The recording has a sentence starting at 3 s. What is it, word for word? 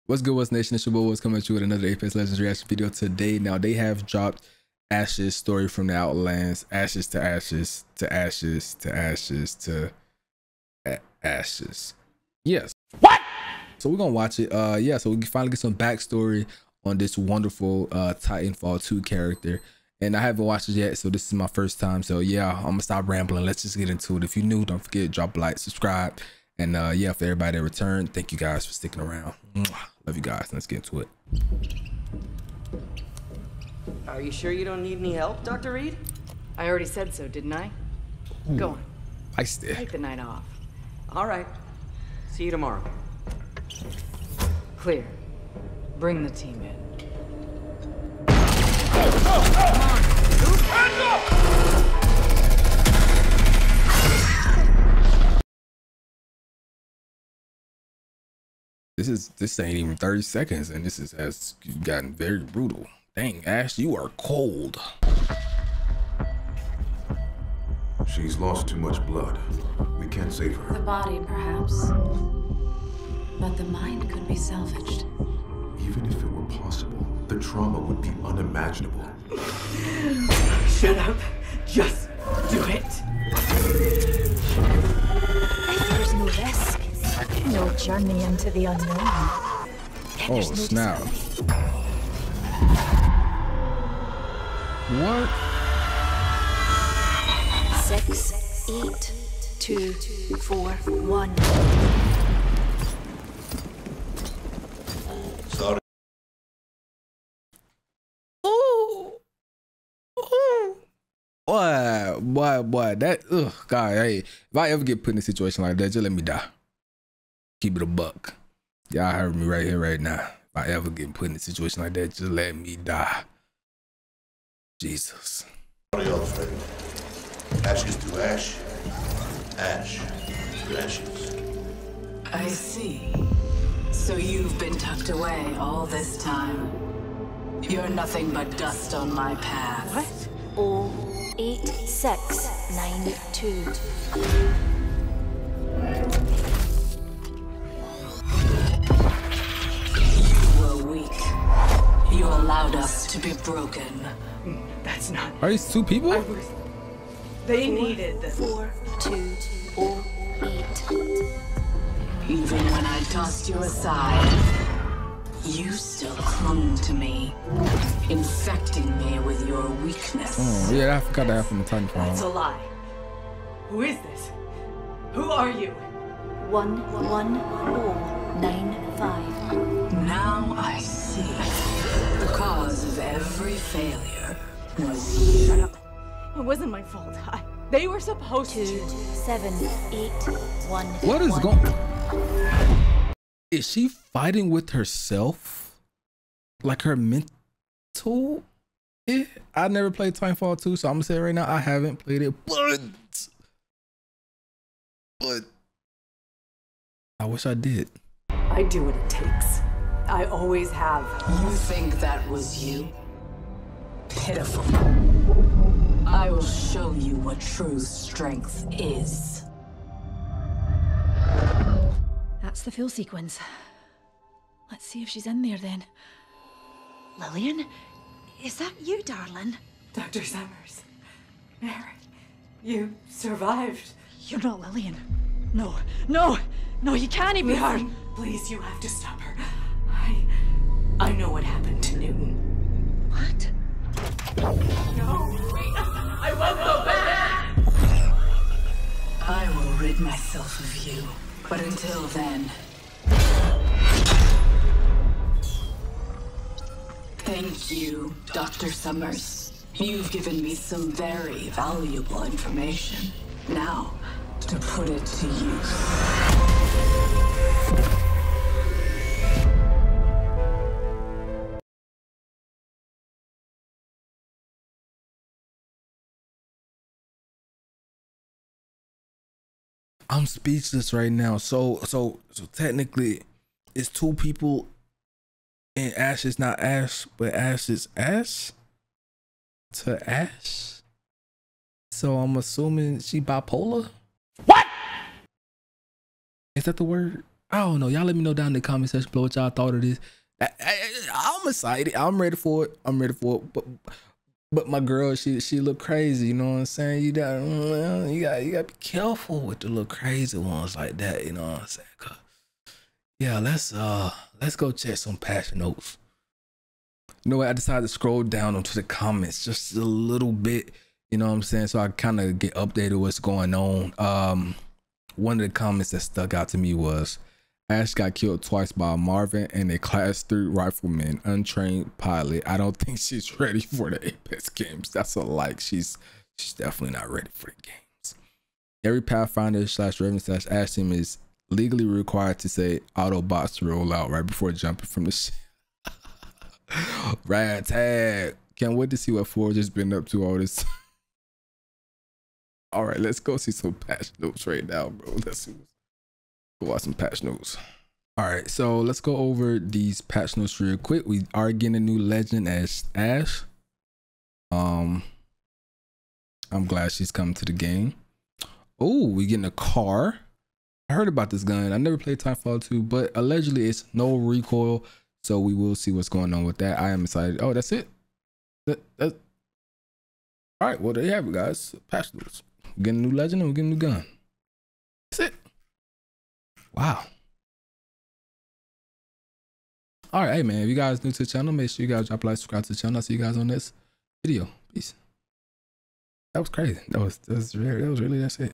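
Now, they have dropped Ash's story from the Outlands, Ashes to Ashes to Ashes to Ashes to Ashes.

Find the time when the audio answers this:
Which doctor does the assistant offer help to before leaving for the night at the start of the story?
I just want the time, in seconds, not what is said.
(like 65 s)
35 s.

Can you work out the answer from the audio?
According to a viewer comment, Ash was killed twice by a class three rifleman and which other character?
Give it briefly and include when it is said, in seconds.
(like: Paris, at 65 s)
Marvin, at 328 s.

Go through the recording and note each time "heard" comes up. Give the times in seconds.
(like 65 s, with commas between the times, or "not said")
119 s, 370 s.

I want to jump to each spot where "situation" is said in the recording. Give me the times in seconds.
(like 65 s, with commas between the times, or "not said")
115 s, 121 s.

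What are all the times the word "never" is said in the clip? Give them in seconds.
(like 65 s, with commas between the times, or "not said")
199 s, 371 s.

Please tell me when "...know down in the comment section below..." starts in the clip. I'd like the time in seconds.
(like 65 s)
298 s.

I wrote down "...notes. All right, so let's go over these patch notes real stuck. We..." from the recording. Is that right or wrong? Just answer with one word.
wrong.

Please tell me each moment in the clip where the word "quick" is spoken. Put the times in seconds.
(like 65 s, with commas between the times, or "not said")
360 s.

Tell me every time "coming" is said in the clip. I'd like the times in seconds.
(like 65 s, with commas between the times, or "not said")
1 s, 367 s.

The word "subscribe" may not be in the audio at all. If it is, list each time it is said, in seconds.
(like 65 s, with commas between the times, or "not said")
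25 s, 392 s.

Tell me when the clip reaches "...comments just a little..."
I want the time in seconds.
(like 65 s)
318 s.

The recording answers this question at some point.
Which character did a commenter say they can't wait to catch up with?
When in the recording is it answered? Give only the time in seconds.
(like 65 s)
349 s.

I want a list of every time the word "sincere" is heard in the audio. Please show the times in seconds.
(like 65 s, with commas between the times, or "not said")
not said.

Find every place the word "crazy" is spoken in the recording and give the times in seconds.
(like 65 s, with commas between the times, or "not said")
305 s, 309 s, 396 s.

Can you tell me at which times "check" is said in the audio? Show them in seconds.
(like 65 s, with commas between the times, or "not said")
314 s.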